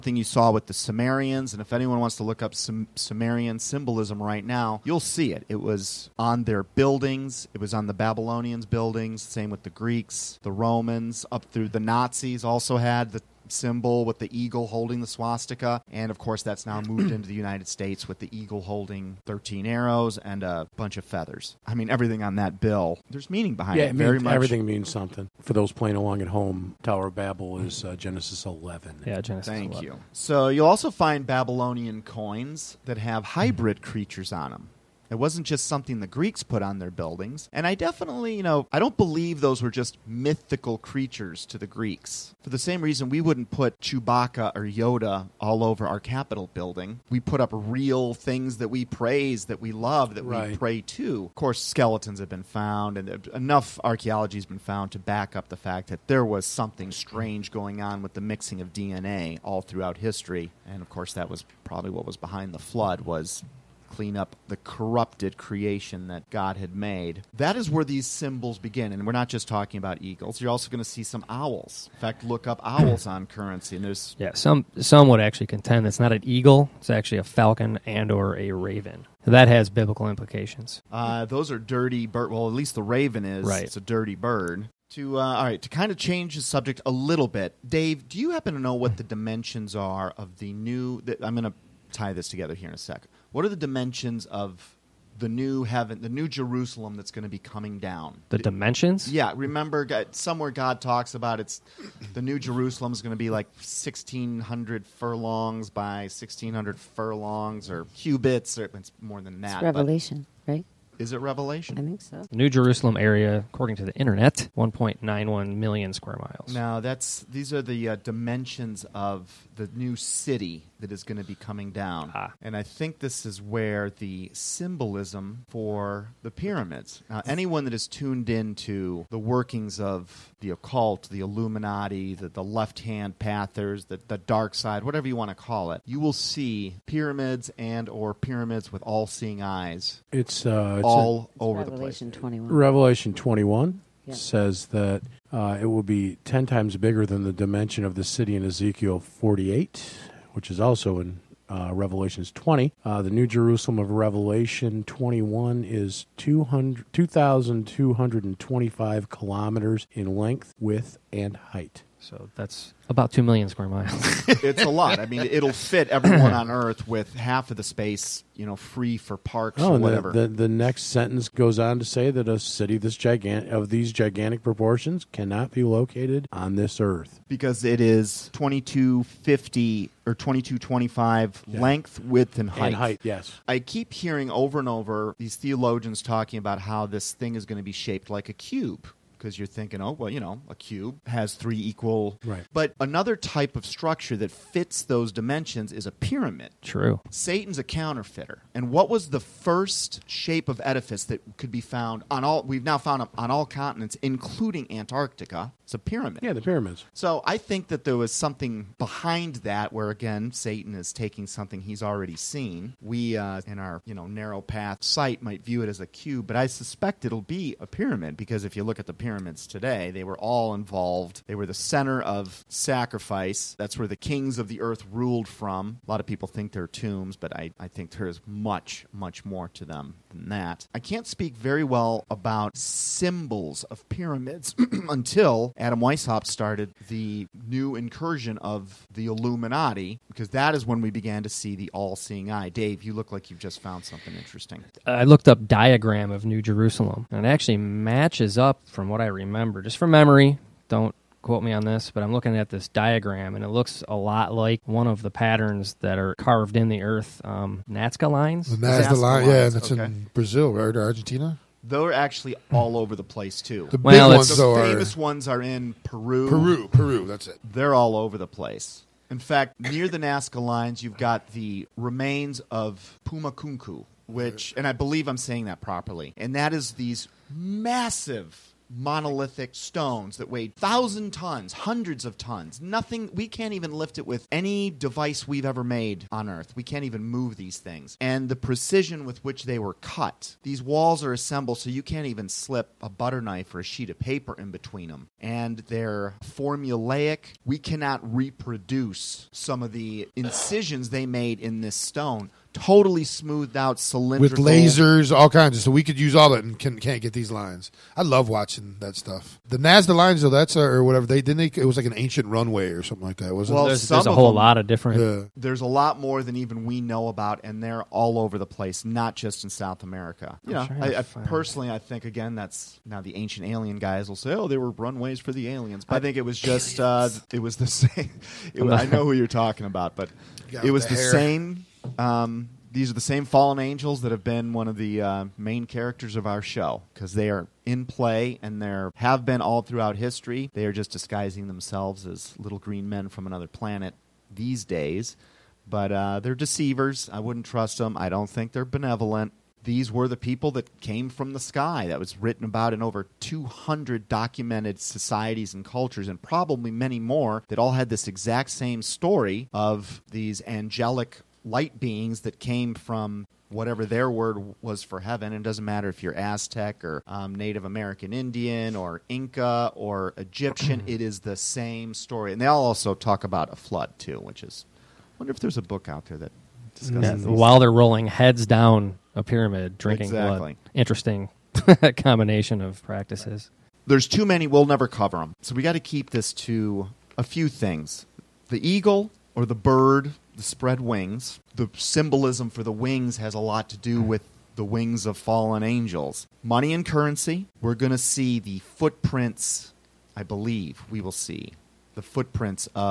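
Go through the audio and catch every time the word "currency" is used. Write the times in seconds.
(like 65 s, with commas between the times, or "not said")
73 s, 396 s.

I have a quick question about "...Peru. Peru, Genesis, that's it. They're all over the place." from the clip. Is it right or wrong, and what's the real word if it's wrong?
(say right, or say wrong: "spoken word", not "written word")
wrong: "Peru", not "Genesis".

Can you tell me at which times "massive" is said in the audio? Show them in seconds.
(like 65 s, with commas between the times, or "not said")
277 s.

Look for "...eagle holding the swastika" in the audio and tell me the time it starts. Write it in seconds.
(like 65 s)
14 s.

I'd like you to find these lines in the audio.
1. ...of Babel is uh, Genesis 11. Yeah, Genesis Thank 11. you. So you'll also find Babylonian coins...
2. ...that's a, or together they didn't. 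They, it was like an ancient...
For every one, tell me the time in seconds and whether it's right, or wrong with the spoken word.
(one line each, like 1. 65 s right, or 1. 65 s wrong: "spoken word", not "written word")
1. 27 s right
2. 310 s wrong: "whatever", not "together".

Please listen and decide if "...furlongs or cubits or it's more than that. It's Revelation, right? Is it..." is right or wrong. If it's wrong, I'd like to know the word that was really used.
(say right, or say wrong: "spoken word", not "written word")
right.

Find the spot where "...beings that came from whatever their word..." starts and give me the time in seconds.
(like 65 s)
361 s.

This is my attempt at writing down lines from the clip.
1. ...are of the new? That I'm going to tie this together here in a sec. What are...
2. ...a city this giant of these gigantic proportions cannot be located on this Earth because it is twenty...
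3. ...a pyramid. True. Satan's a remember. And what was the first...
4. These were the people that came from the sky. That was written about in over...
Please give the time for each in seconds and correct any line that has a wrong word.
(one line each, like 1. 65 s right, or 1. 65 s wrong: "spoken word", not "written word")
1. 89 s right
2. 172 s right
3. 195 s wrong: "counterfeiter", not "remember"
4. 349 s right.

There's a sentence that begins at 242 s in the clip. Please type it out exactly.
Dave, you look like you've just found something interesting.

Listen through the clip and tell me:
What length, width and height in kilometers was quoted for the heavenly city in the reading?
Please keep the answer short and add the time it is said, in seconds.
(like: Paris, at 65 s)
2,225 kilometers, at 156 s.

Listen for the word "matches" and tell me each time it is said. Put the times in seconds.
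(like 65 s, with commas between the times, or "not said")
247 s.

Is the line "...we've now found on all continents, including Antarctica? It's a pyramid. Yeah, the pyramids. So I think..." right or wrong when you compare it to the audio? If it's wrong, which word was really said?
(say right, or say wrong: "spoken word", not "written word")
right.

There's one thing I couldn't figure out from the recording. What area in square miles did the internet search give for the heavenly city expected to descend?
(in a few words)
1.91 million square miles.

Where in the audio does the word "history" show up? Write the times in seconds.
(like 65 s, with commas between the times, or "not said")
59 s, 339 s.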